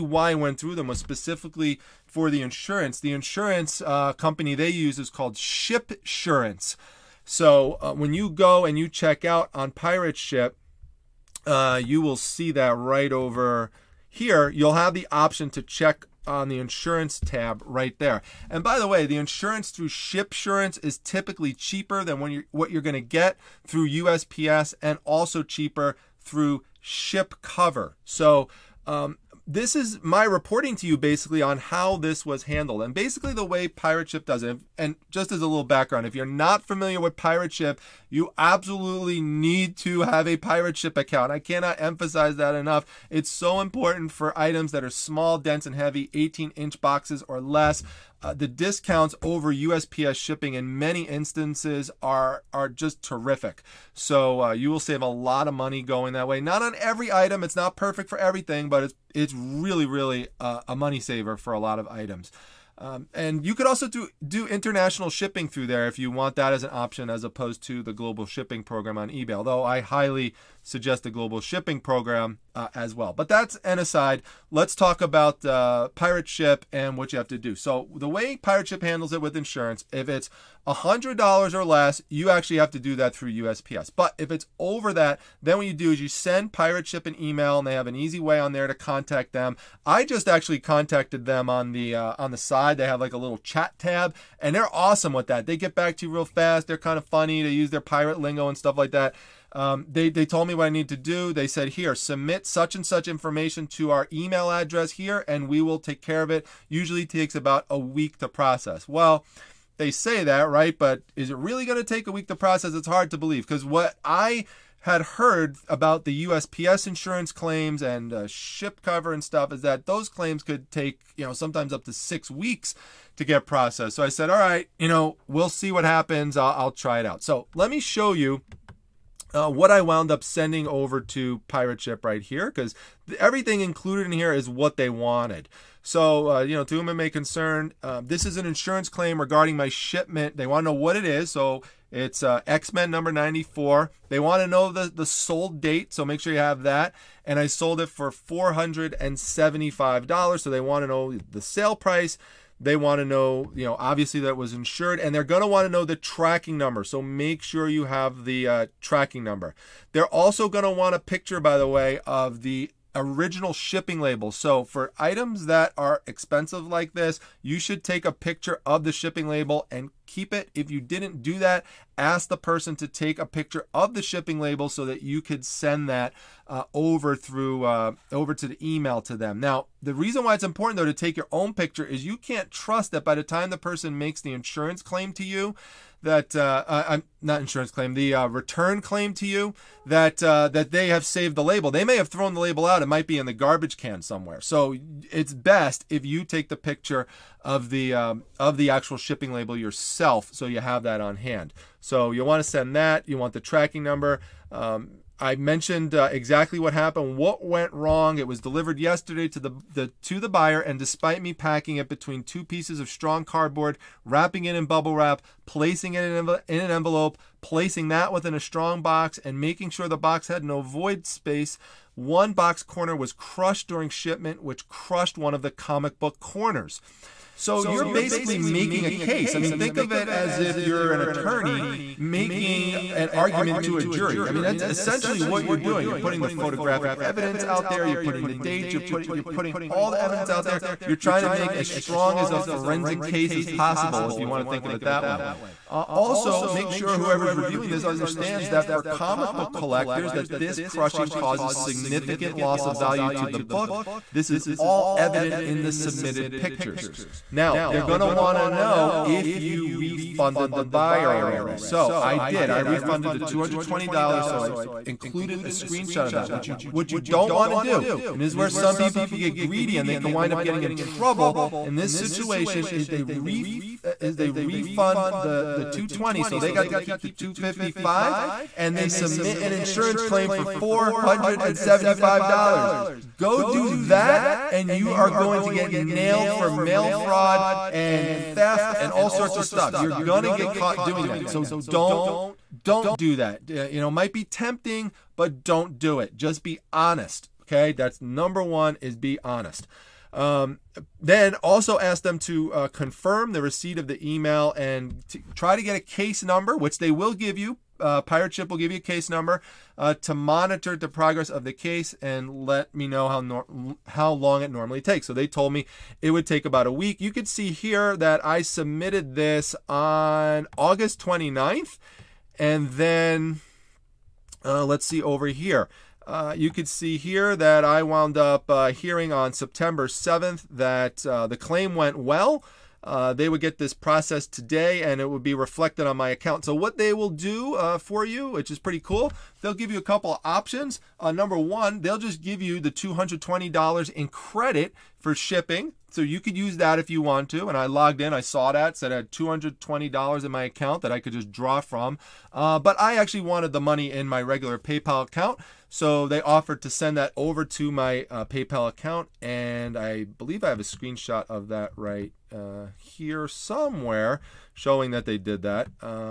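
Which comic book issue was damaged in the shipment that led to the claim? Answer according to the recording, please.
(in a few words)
X-Men #94.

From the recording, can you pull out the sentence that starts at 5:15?
So they told me it would take about a week.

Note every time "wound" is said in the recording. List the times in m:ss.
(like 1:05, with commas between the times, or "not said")
2:09, 5:27.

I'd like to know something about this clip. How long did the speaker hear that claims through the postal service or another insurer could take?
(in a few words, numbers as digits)
6 weeks.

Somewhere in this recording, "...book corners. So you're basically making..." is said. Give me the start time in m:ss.
3:45.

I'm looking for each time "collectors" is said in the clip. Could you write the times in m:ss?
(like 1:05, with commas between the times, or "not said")
4:09.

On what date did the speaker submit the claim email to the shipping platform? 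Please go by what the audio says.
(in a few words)
August 29.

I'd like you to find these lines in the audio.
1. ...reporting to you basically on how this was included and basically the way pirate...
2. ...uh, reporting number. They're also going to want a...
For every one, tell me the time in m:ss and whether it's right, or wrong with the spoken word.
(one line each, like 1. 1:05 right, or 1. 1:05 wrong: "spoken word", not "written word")
1. 0:30 wrong: "handled", not "included"
2. 2:38 wrong: "tracking", not "reporting".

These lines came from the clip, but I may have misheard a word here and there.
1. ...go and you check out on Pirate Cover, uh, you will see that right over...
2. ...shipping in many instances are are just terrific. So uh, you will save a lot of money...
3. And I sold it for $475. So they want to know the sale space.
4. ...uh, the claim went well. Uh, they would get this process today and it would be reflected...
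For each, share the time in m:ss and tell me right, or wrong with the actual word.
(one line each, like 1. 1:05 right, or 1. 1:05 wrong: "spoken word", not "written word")
1. 0:08 wrong: "Ship", not "Cover"
2. 0:50 right
3. 2:27 wrong: "price", not "space"
4. 5:31 right.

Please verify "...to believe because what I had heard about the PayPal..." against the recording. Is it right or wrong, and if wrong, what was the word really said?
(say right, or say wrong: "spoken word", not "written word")
wrong: "USPS", not "PayPal".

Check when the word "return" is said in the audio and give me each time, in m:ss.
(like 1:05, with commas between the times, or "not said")
3:08.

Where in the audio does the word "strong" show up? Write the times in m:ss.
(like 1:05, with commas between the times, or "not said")
3:32, 3:38, 4:01.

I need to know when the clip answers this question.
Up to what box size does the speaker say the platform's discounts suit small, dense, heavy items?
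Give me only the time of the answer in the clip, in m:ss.
0:46.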